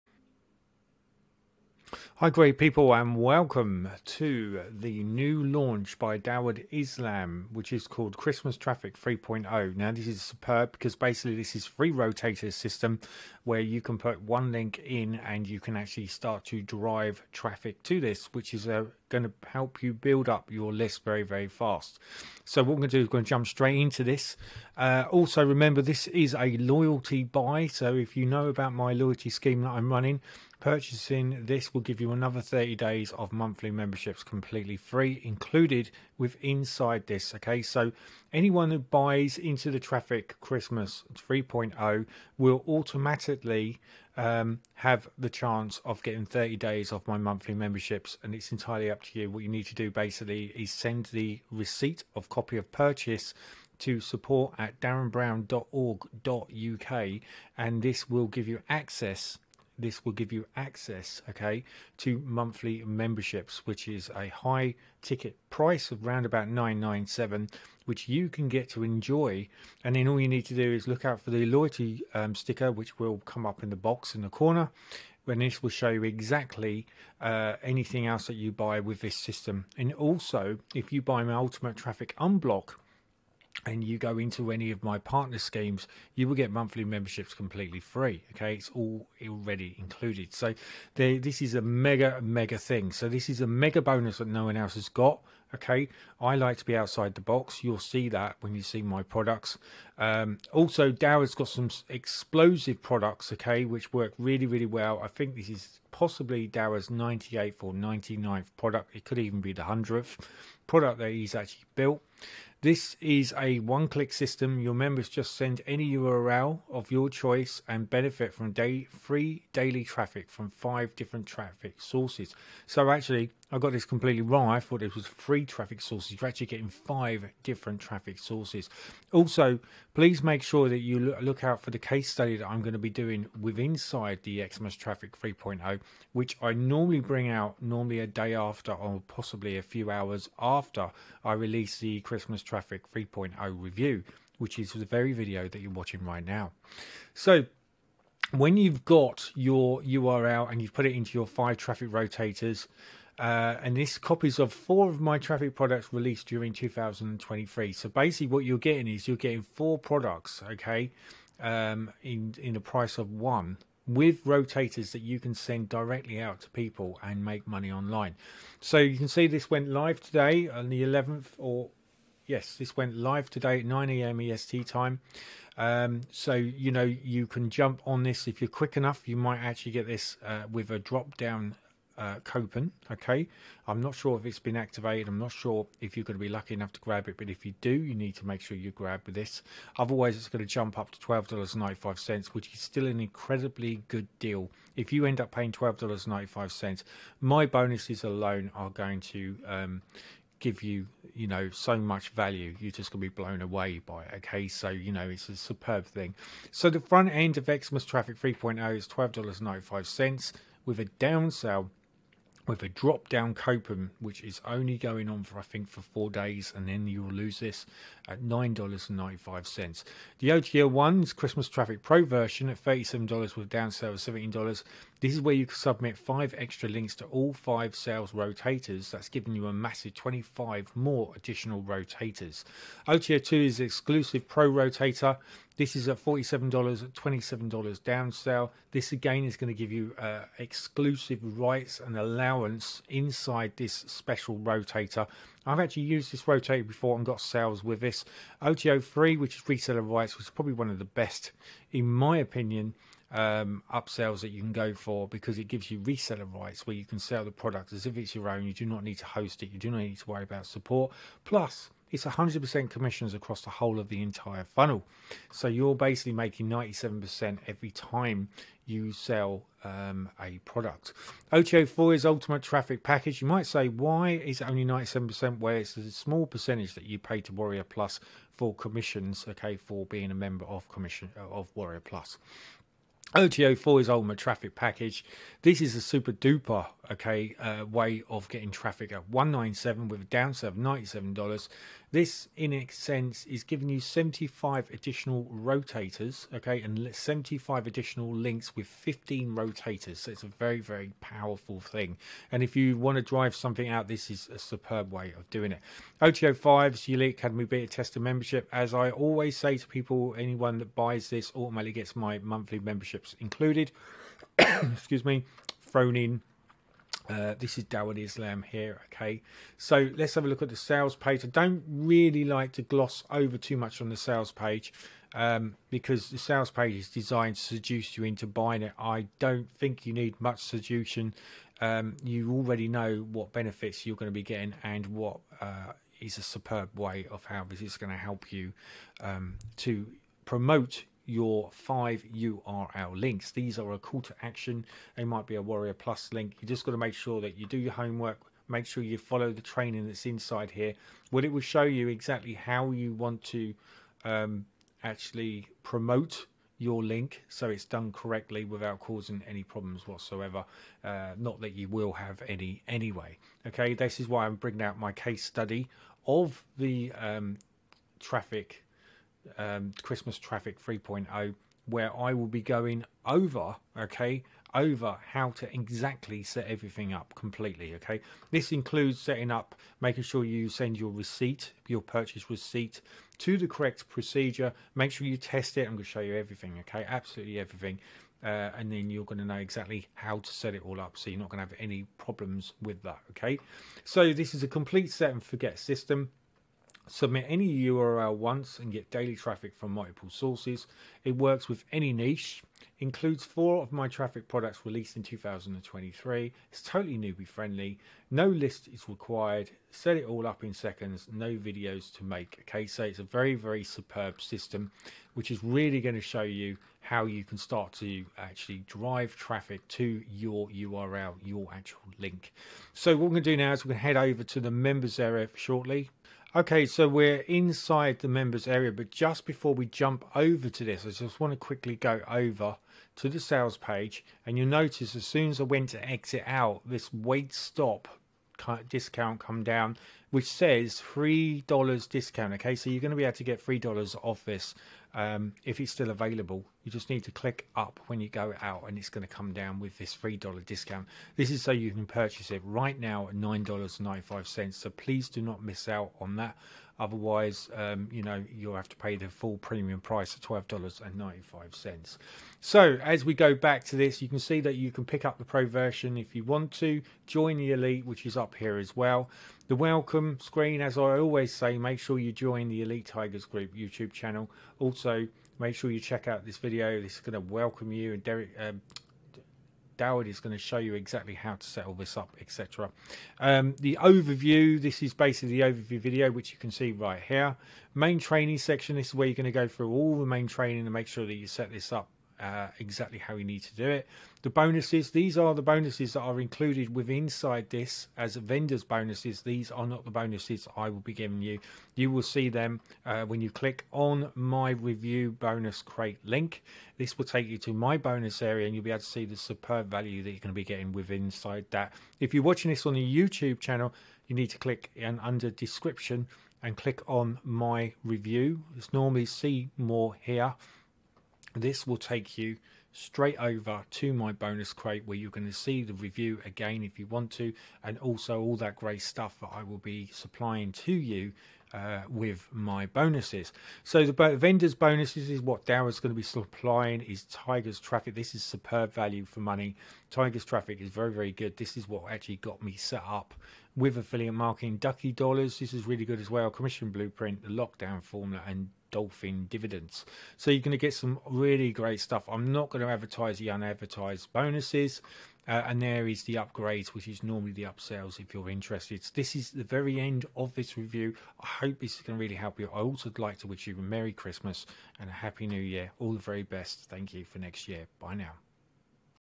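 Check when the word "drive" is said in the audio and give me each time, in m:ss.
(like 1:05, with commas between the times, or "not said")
0:16, 5:03, 6:58.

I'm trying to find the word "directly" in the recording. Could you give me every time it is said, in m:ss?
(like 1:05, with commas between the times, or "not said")
2:45.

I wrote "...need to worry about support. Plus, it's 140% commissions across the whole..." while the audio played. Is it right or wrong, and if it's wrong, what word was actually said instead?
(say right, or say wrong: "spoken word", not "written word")
wrong: "100", not "140".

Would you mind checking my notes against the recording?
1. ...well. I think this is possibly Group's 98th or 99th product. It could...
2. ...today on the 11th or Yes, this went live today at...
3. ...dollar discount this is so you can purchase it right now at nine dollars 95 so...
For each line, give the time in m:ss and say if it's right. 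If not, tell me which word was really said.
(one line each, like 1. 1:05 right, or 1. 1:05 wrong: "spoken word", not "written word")
1. 1:44 wrong: "Dower", not "Group"
2. 2:50 right
3. 7:30 right.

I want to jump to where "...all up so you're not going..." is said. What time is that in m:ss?
6:30.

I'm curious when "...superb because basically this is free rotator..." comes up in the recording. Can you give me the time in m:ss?
0:10.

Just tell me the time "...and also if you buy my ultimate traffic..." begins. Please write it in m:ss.
1:19.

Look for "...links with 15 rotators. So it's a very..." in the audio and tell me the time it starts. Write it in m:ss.
4:58.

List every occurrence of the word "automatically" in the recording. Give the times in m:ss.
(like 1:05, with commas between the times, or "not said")
0:42, 5:11.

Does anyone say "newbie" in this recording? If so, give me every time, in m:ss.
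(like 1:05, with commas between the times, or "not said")
6:46.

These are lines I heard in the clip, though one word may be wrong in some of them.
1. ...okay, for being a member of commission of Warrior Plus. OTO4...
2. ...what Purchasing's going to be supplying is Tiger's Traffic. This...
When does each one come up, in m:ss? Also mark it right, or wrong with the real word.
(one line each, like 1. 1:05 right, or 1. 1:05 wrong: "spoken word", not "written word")
1. 4:39 right
2. 8:55 wrong: "Dara", not "Purchasing".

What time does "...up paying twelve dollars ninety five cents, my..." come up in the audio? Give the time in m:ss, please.
3:15.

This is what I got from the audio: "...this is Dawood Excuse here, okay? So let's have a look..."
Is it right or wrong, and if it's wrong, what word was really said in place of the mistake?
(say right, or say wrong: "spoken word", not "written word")
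wrong: "Islam", not "Excuse".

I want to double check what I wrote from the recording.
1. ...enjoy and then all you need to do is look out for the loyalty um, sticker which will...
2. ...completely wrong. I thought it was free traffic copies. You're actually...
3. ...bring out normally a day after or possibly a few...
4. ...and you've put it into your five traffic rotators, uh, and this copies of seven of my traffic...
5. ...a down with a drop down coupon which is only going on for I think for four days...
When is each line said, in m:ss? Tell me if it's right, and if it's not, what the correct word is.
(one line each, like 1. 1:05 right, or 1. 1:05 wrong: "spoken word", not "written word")
1. 1:08 right
2. 2:03 wrong: "sources", not "copies"
3. 2:17 right
4. 2:30 wrong: "four", not "seven"
5. 3:30 right.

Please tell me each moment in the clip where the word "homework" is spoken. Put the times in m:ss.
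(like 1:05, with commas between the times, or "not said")
5:47.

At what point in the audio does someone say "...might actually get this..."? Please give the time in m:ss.
2:59.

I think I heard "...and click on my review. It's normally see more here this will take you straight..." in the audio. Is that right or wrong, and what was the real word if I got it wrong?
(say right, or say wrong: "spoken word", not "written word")
right.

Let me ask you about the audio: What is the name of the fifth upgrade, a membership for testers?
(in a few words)
Elite Academy Beta Tester.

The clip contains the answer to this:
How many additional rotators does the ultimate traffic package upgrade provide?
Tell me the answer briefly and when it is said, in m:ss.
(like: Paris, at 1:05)
75, at 4:53.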